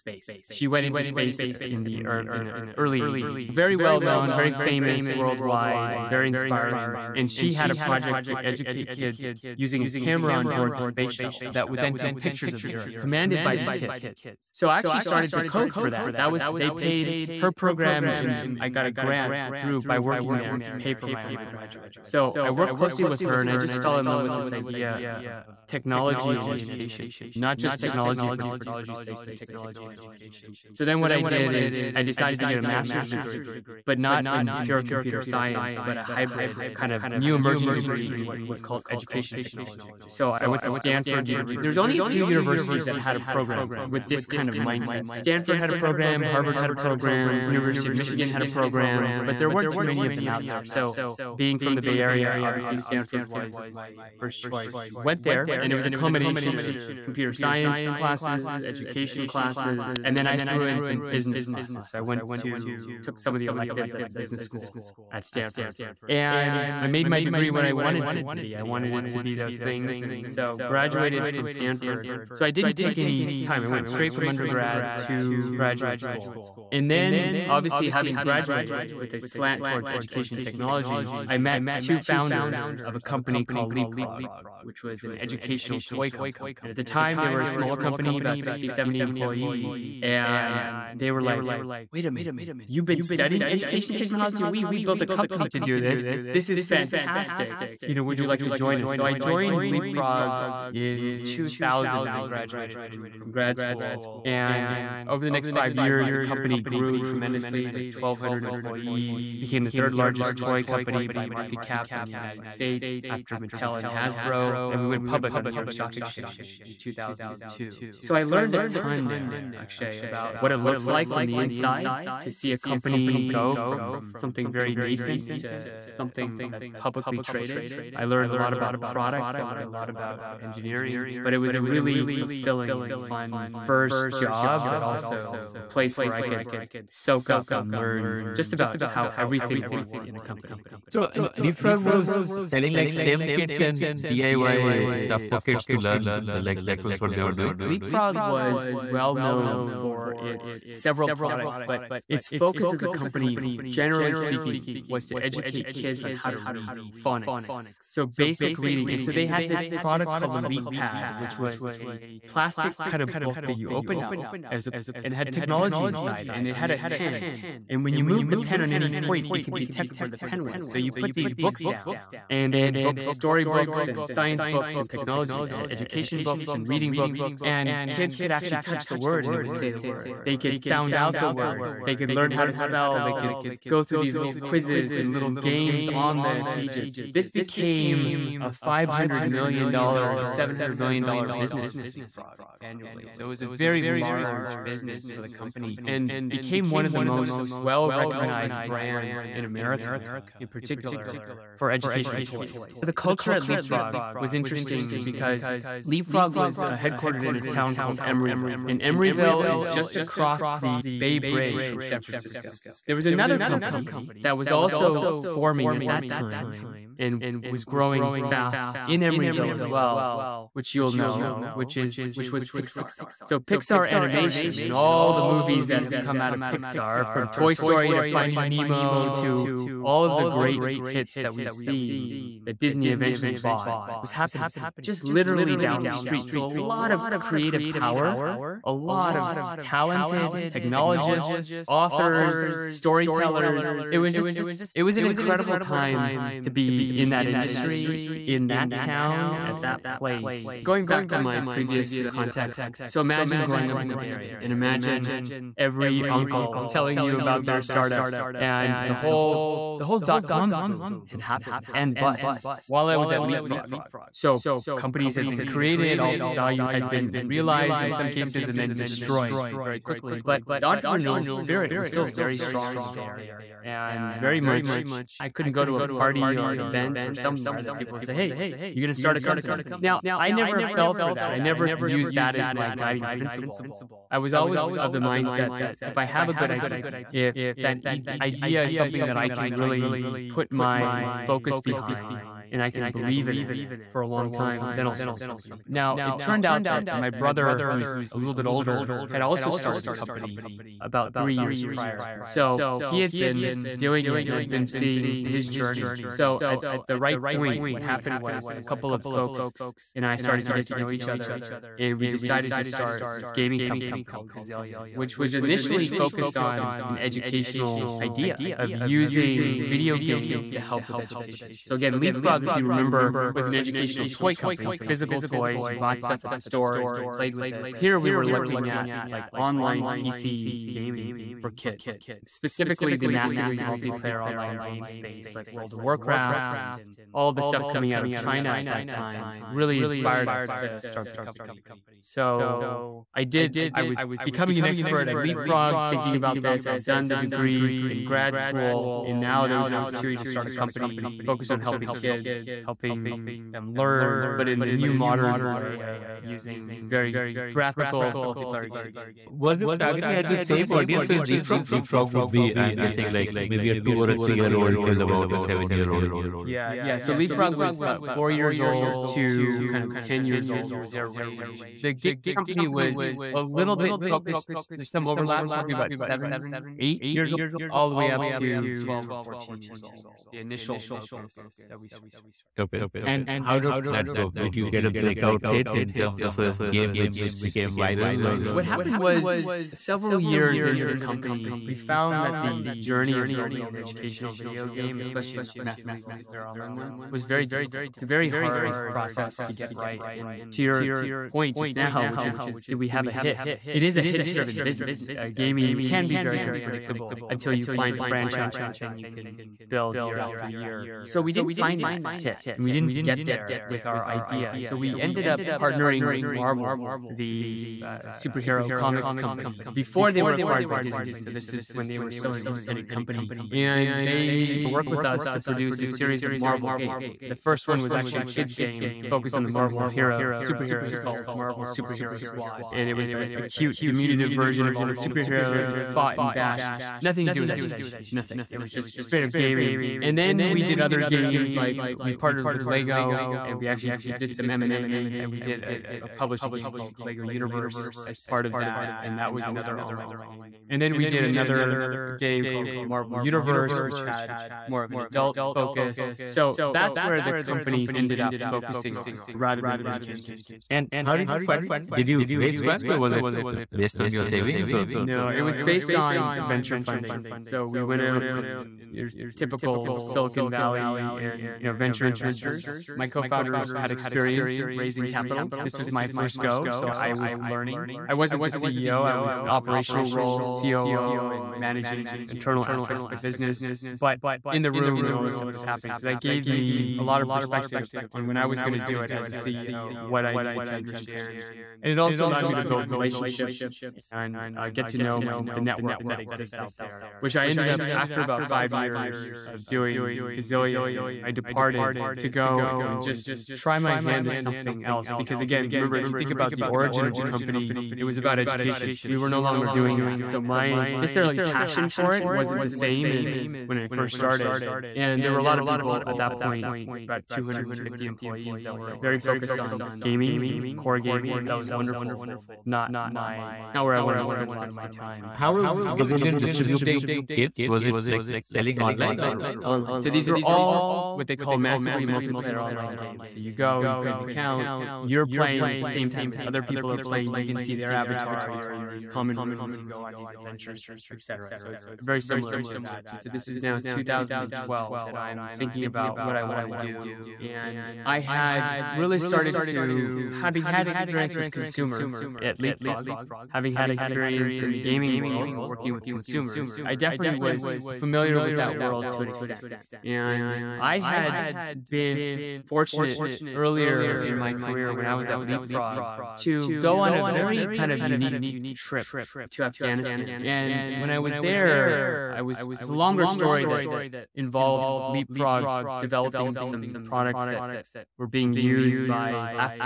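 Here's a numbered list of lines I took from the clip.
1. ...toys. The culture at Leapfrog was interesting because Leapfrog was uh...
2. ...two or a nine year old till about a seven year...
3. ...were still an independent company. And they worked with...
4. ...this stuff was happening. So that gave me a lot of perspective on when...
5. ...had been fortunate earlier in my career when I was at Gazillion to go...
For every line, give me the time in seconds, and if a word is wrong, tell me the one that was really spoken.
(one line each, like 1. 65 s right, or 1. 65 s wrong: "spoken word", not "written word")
1. 202 s right
2. 363 s wrong: "three", not "nine"
3. 421 s right
4. 485 s right
5. 560 s wrong: "Leapfrog", not "Gazillion".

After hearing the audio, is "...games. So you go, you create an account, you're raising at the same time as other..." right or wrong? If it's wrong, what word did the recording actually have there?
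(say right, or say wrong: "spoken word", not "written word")
wrong: "playing", not "raising".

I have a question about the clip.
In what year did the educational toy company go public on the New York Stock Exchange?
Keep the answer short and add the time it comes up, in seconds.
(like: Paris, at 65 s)
2002, at 116 s.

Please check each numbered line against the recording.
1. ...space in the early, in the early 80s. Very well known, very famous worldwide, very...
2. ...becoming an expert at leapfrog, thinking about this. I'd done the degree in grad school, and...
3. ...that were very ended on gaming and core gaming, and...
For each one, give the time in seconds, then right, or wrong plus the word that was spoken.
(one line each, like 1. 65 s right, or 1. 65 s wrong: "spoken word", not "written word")
1. 1 s right
2. 344 s right
3. 518 s wrong: "focused", not "ended".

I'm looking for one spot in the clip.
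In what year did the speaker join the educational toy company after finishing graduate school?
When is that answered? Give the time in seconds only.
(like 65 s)
101 s.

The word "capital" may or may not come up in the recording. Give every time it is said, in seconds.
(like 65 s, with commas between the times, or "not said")
475 s.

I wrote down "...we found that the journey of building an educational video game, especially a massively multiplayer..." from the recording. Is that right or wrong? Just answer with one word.
right.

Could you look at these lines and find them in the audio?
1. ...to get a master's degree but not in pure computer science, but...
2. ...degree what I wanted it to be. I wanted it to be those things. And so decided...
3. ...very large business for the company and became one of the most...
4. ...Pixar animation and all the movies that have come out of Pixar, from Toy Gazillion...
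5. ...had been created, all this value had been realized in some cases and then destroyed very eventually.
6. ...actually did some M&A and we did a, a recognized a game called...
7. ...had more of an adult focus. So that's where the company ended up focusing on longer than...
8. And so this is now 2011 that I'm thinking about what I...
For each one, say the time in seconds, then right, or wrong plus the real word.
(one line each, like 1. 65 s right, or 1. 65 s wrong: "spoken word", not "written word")
1. 32 s right
2. 67 s wrong: "graduated", not "decided"
3. 193 s right
4. 223 s wrong: "Story", not "Gazillion"
5. 265 s wrong: "quickly", not "eventually"
6. 443 s wrong: "published", not "recognized"
7. 454 s wrong: "rather", not "longer"
8. 543 s wrong: "2012", not "2011".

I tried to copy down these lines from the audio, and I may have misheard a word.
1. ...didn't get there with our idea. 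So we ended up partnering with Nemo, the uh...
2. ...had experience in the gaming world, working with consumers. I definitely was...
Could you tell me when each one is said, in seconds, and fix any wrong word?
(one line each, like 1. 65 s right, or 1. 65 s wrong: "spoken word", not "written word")
1. 412 s wrong: "Marvel", not "Nemo"
2. 553 s right.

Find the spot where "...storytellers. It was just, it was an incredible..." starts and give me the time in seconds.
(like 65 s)
242 s.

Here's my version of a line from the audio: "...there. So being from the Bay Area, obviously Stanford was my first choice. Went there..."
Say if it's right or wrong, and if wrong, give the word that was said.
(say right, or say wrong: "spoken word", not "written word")
right.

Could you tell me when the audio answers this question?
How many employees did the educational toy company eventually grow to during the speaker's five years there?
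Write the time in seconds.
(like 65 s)
107 s.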